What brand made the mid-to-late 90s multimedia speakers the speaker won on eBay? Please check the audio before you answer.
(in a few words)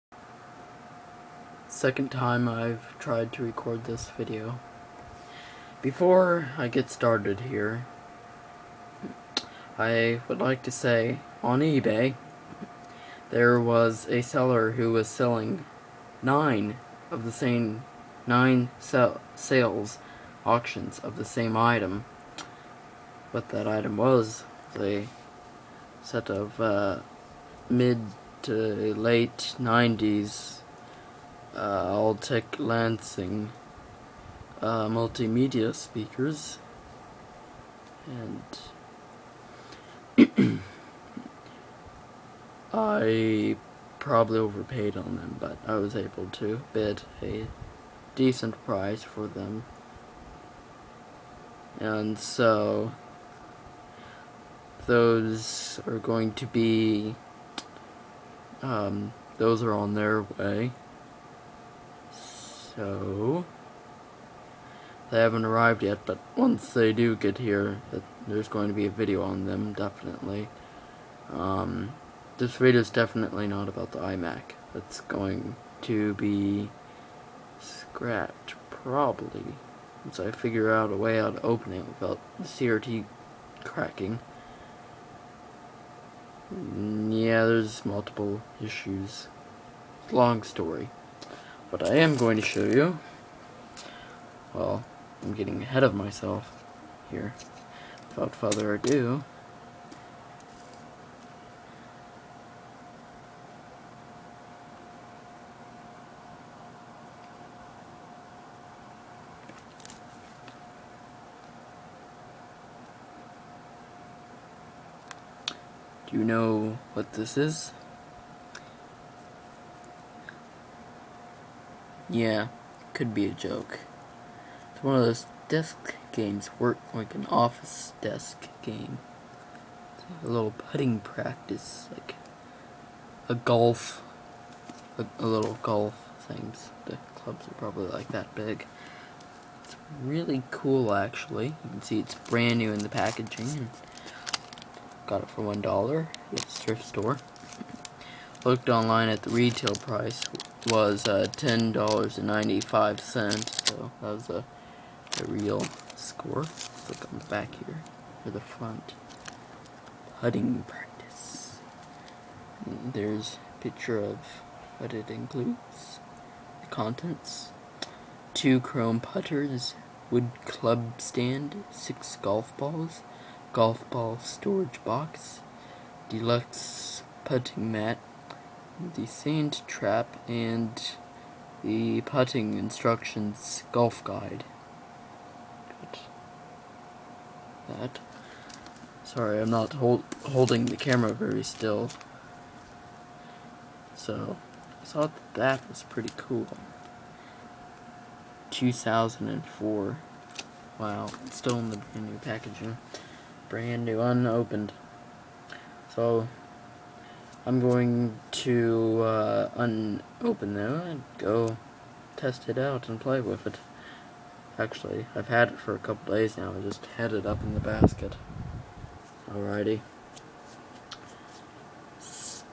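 Alltech Lansing.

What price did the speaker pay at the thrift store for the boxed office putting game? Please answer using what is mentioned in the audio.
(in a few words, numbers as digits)
$1.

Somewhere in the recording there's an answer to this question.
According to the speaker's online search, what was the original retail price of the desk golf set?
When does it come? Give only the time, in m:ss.
2:31.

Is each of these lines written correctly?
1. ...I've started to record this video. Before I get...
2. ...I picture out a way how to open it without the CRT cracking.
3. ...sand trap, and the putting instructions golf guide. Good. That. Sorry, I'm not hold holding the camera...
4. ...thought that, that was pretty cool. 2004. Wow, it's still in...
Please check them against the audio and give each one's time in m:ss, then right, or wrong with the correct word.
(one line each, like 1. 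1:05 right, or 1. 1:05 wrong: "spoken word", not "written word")
1. 0:02 wrong: "tried", not "started"
2. 1:20 wrong: "figure", not "picture"
3. 2:59 right
4. 3:14 right.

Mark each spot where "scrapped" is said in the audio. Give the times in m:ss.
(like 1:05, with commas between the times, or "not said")
1:17.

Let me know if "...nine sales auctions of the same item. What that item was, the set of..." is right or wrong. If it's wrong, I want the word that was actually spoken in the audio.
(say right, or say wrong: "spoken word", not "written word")
right.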